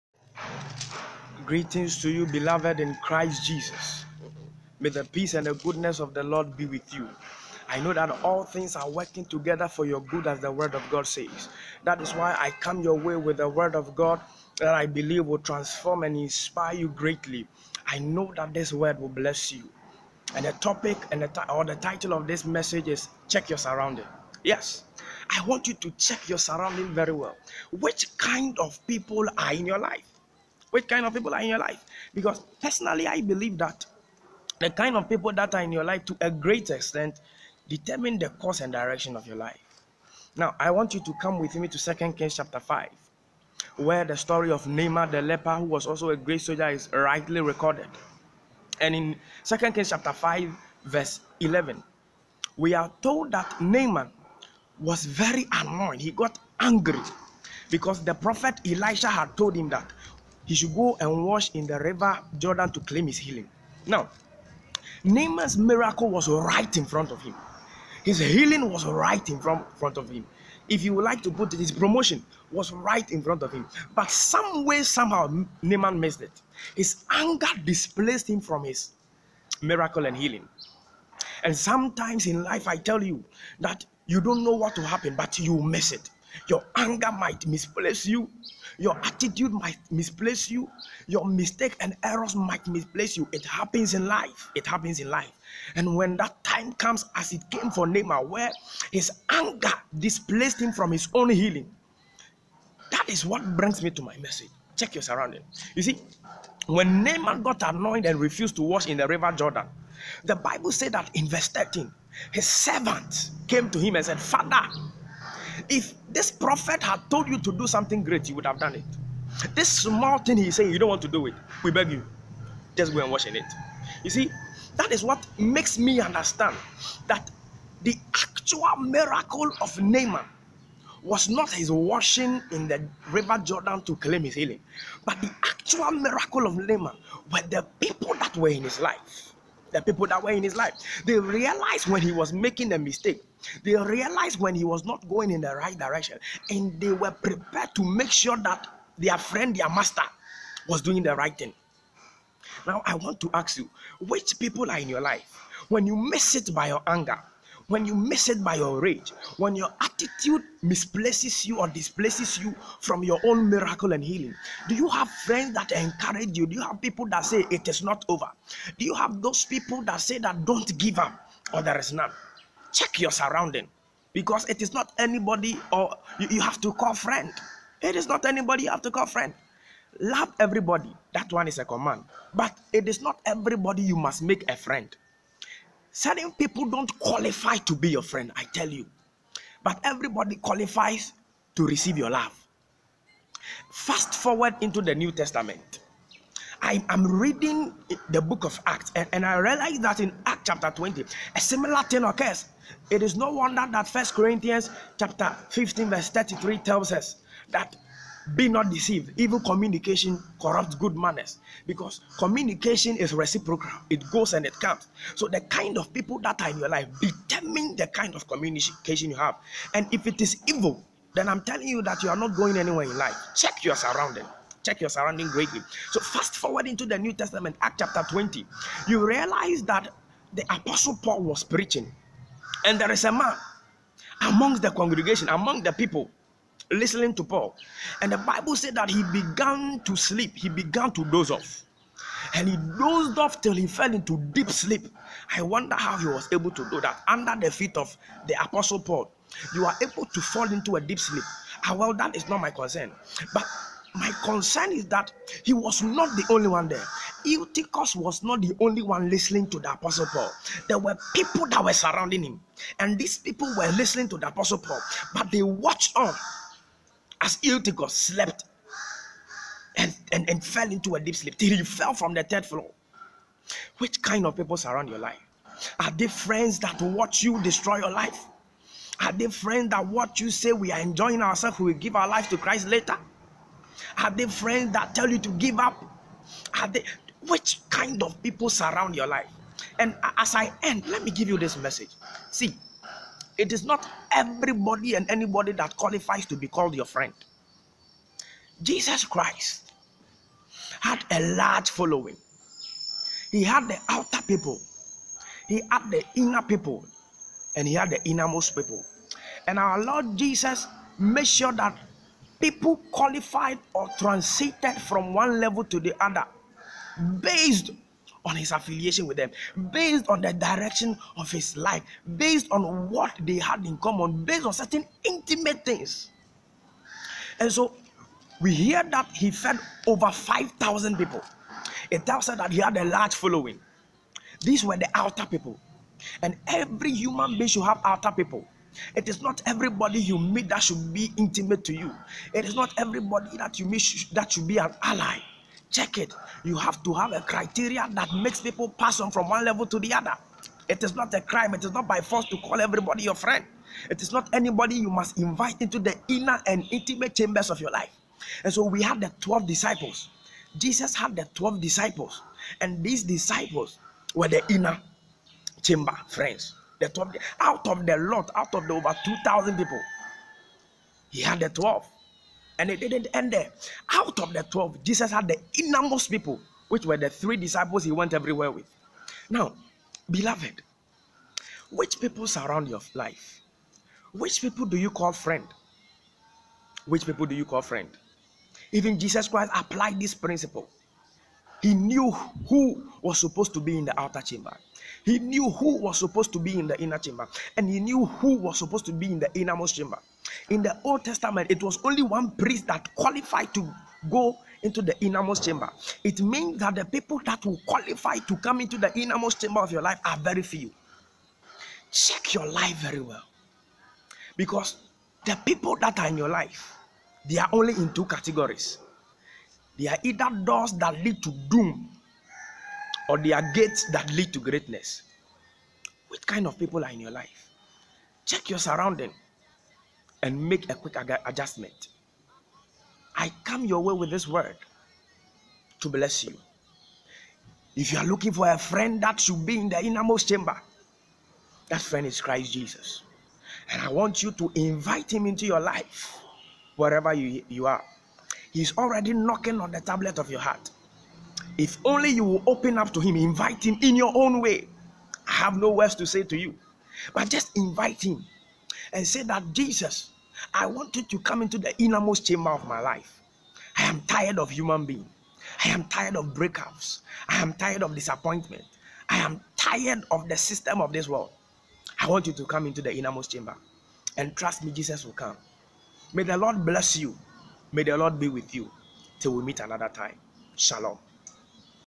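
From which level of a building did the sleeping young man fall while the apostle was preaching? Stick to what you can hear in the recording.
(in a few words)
Third floor.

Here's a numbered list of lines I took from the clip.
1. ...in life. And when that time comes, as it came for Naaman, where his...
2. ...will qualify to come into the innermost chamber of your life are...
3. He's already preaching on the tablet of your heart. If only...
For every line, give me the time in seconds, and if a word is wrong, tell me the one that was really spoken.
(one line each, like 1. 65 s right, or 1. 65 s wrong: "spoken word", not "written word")
1. 94 s right
2. 407 s right
3. 448 s wrong: "knocking", not "preaching".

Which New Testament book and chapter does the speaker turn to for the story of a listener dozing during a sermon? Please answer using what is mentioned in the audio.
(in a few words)
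Acts chapter 20.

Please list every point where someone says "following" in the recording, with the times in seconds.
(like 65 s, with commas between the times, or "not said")
301 s, 333 s.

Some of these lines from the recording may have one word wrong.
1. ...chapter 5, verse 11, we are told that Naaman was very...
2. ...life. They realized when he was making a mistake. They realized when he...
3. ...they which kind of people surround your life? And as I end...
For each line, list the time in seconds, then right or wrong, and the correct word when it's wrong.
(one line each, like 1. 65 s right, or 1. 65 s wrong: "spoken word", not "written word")
1. 49 s right
2. 140 s right
3. 286 s right.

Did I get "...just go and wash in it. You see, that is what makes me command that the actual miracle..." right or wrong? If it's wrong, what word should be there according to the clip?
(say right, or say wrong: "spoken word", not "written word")
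wrong: "understand", not "command".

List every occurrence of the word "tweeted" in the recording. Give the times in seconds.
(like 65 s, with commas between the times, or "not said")
not said.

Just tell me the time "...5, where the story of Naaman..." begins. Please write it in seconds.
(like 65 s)
42 s.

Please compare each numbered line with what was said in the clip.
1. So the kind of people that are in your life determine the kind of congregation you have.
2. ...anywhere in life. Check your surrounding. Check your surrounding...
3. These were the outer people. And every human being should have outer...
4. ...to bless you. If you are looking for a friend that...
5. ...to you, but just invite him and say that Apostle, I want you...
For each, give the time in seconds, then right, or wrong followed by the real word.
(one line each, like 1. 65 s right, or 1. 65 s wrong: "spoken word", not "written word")
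1. 215 s wrong: "communication", not "congregation"
2. 222 s right
3. 334 s right
4. 435 s right
5. 456 s wrong: "Jesus", not "Apostle".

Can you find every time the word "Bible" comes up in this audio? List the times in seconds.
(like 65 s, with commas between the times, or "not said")
110 s, 238 s.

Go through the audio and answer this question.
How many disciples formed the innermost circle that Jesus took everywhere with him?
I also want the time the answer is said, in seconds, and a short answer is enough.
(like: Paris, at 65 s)
3, at 377 s.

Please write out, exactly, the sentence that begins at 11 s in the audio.
That is why I come your way with the Word of God that I believe will transform and inspire you greatly.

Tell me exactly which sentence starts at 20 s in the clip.
And the topic and the or the title of this message is Check Your Surrounding.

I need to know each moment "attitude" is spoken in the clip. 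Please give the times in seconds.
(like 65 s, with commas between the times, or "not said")
89 s, 159 s.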